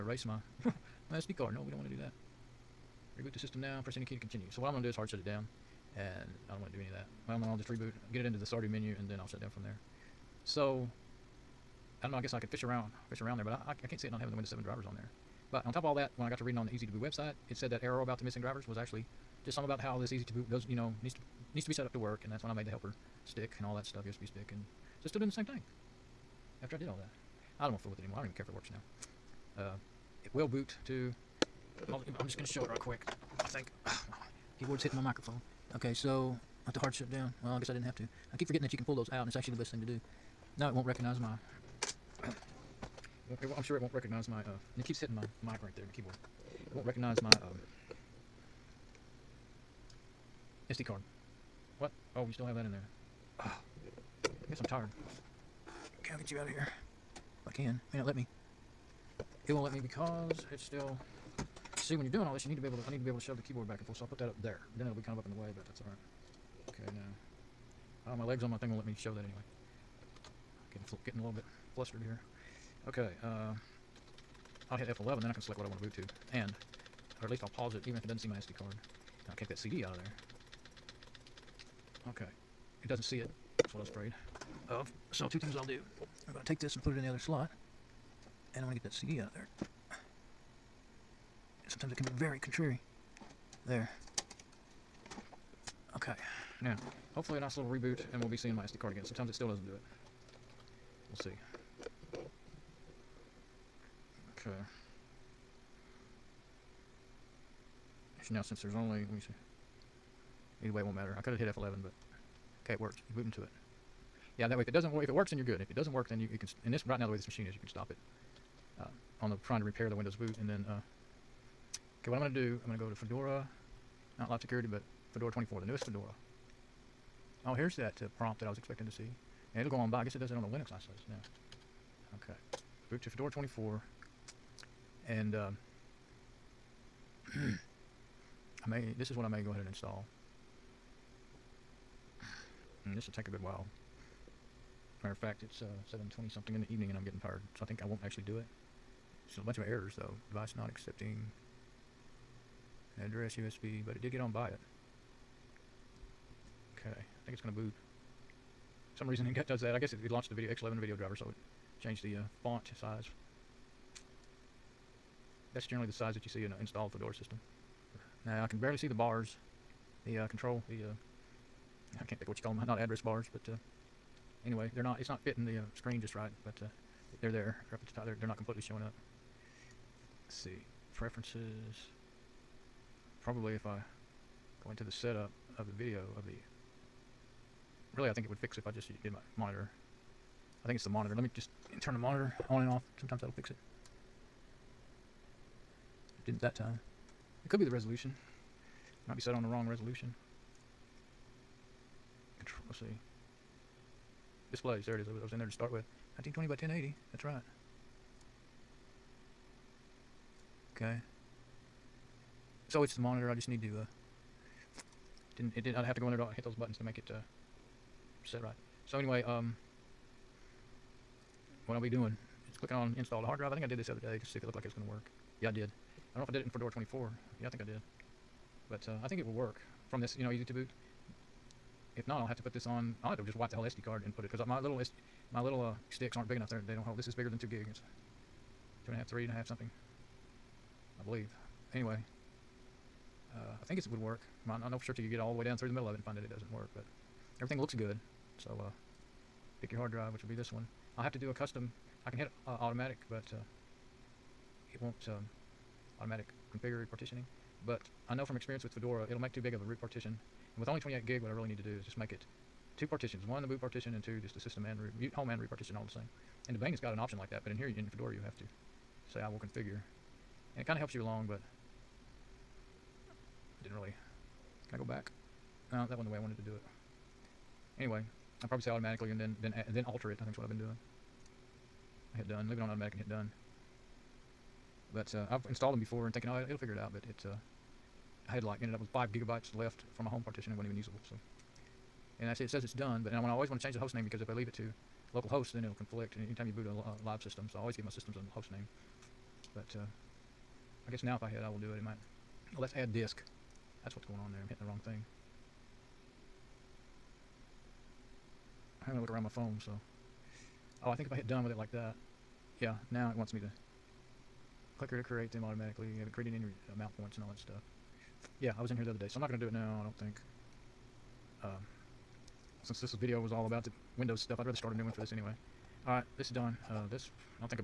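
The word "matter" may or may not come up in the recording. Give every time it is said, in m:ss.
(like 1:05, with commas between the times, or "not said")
1:50, 2:25.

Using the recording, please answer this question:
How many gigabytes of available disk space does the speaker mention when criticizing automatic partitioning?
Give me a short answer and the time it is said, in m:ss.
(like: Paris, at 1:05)
28, at 4:20.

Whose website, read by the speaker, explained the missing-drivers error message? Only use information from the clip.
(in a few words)
Easy2Boot.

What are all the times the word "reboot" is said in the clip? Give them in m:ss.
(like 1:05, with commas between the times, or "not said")
0:03, 0:07, 1:37.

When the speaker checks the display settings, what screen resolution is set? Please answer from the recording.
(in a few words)
1920 by 1080.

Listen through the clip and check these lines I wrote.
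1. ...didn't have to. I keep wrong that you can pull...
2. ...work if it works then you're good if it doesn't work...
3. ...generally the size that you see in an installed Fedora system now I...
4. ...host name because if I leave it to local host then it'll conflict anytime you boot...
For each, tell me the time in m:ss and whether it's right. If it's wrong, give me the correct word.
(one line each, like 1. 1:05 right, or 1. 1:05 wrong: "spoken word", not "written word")
1. 0:37 wrong: "forgetting", not "wrong"
2. 1:54 right
3. 2:45 right
4. 4:53 right.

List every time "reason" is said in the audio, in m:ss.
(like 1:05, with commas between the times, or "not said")
2:39.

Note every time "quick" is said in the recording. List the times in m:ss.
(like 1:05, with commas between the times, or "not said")
0:32.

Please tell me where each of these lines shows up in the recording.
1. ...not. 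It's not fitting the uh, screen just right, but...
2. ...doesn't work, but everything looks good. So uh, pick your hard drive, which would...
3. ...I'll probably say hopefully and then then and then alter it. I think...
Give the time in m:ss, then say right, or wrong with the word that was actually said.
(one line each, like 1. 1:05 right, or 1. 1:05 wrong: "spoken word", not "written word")
1. 2:54 right
2. 4:06 right
3. 4:38 wrong: "automatically", not "hopefully".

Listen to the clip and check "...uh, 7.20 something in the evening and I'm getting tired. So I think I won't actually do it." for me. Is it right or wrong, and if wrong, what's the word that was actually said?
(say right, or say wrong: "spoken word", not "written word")
right.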